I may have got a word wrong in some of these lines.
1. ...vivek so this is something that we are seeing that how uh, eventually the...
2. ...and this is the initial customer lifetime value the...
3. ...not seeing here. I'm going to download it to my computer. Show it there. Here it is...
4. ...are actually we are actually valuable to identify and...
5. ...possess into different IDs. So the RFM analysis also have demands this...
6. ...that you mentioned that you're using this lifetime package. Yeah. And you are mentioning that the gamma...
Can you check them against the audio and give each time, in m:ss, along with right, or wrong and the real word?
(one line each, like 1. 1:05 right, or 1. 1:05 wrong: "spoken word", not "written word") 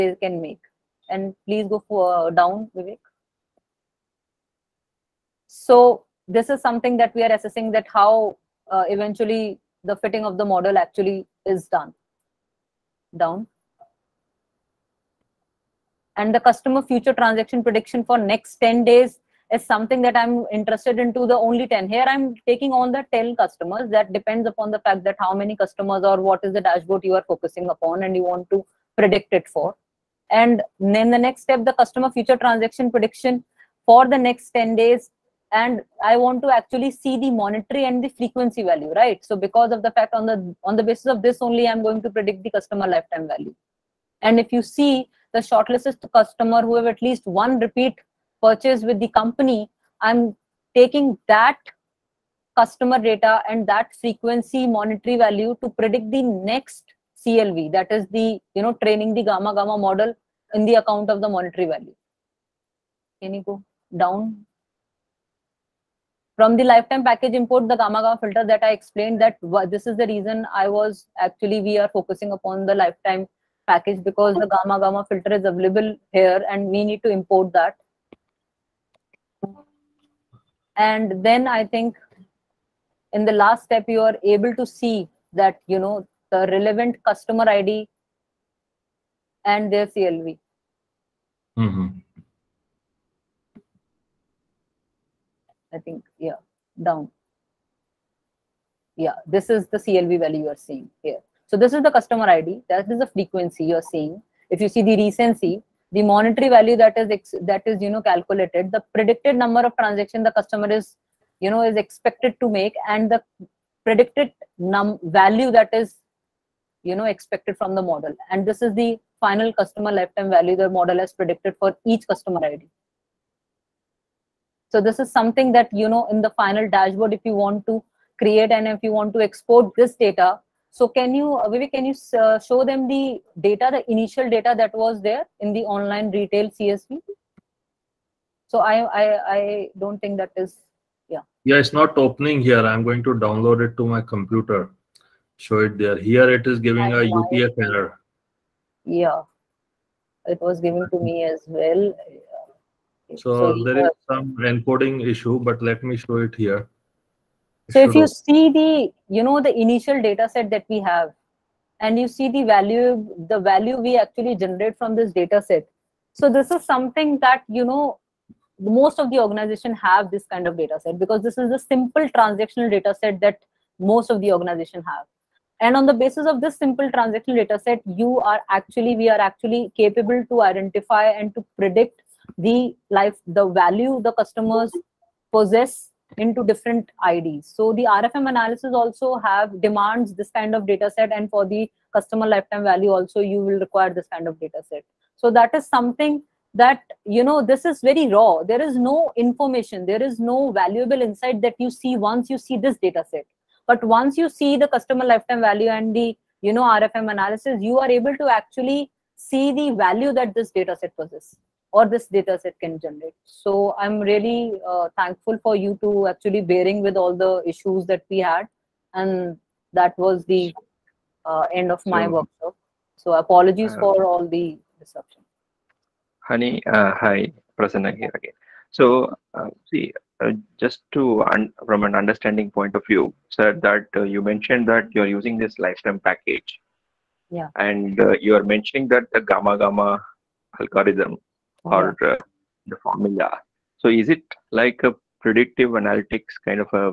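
1. 0:02 wrong: "assessing", not "seeing"
2. 1:58 wrong: "final", not "initial"
3. 2:21 wrong: "opening", not "seeing"
4. 2:58 wrong: "capable", not "valuable"
5. 3:05 right
6. 3:53 right.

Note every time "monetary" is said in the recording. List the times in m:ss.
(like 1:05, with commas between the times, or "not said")
0:37, 0:54, 1:01, 1:46.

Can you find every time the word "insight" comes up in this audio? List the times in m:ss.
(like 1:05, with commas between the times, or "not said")
3:20.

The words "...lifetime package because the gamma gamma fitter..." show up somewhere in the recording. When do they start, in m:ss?
1:12.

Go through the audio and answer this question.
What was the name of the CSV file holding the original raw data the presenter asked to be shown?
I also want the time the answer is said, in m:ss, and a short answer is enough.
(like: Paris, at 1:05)
online retail, at 2:15.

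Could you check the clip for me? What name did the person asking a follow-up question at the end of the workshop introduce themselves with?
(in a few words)
Prasanna.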